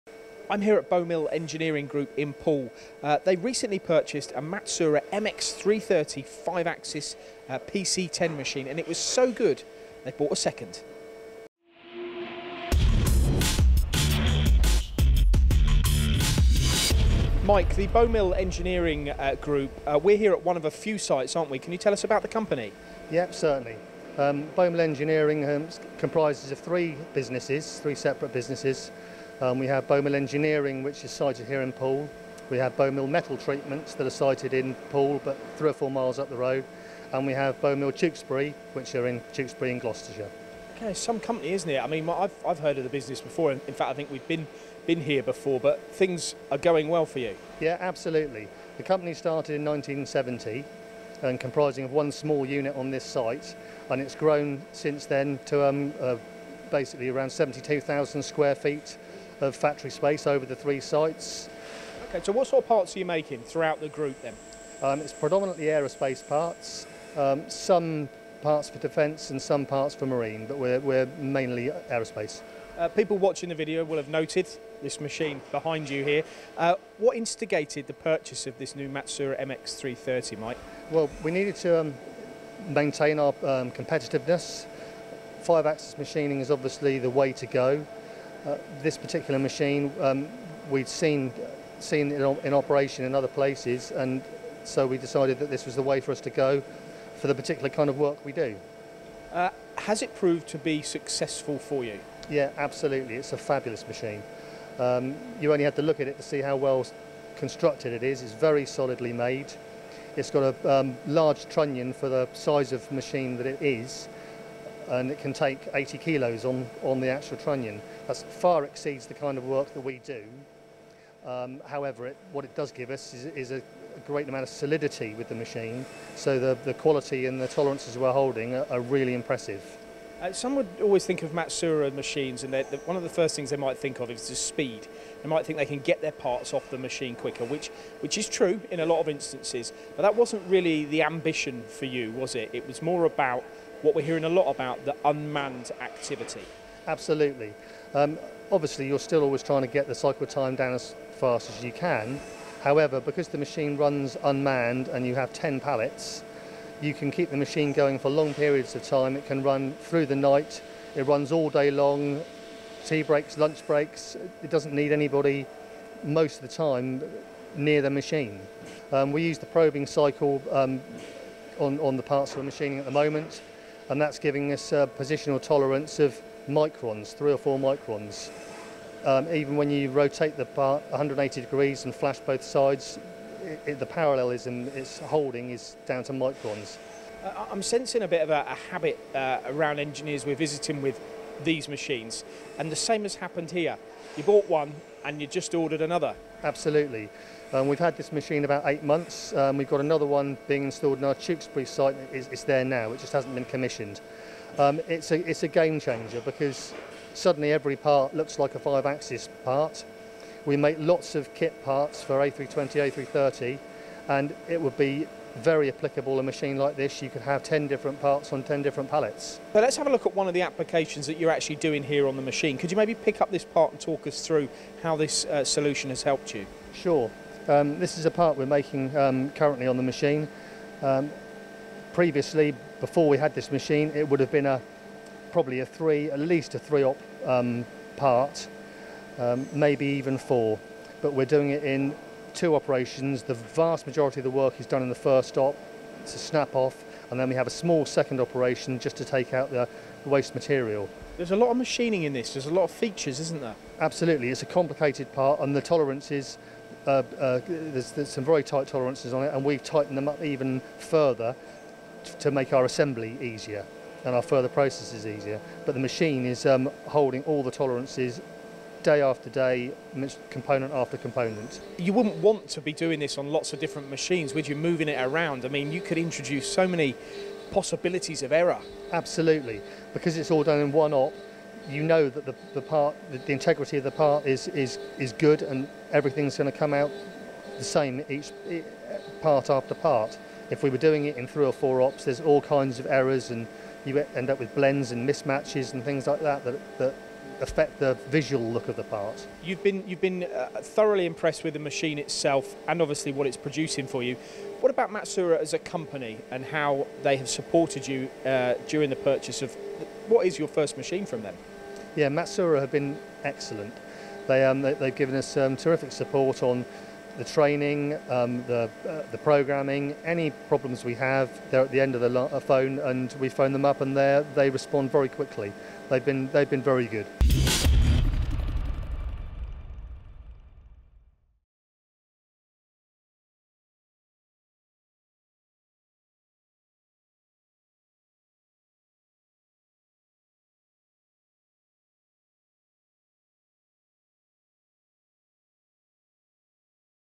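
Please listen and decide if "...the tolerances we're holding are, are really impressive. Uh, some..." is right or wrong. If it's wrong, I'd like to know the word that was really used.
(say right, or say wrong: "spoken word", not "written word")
right.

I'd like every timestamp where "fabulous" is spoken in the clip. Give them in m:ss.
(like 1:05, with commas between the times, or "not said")
1:43.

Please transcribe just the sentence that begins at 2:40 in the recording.
It runs all day long, tea breaks, lunch breaks.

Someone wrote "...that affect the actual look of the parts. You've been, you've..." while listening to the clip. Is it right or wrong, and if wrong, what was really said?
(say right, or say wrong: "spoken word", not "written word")
wrong: "visual", not "actual".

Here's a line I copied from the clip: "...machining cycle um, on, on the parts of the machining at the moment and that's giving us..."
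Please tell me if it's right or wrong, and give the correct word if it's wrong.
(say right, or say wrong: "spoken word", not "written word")
wrong: "probing", not "machining".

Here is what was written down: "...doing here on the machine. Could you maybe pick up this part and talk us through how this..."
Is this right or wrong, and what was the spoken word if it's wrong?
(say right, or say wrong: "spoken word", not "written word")
right.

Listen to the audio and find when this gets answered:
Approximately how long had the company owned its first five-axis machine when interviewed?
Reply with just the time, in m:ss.
3:18.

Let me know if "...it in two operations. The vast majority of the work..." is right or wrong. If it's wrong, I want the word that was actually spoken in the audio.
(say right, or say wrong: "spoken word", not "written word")
right.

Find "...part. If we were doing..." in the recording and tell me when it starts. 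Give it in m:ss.
4:49.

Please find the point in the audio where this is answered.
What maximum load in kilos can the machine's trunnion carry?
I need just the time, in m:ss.
1:55.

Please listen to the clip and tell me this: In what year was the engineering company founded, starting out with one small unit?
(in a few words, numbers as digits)
1970.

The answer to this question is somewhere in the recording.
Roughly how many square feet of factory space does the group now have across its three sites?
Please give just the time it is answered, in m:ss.
0:57.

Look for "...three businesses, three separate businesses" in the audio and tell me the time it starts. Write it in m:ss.
0:26.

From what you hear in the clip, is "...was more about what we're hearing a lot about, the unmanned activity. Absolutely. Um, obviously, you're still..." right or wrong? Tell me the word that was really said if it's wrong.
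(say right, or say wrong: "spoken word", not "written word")
right.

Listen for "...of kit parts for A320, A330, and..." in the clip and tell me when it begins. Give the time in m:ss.
3:31.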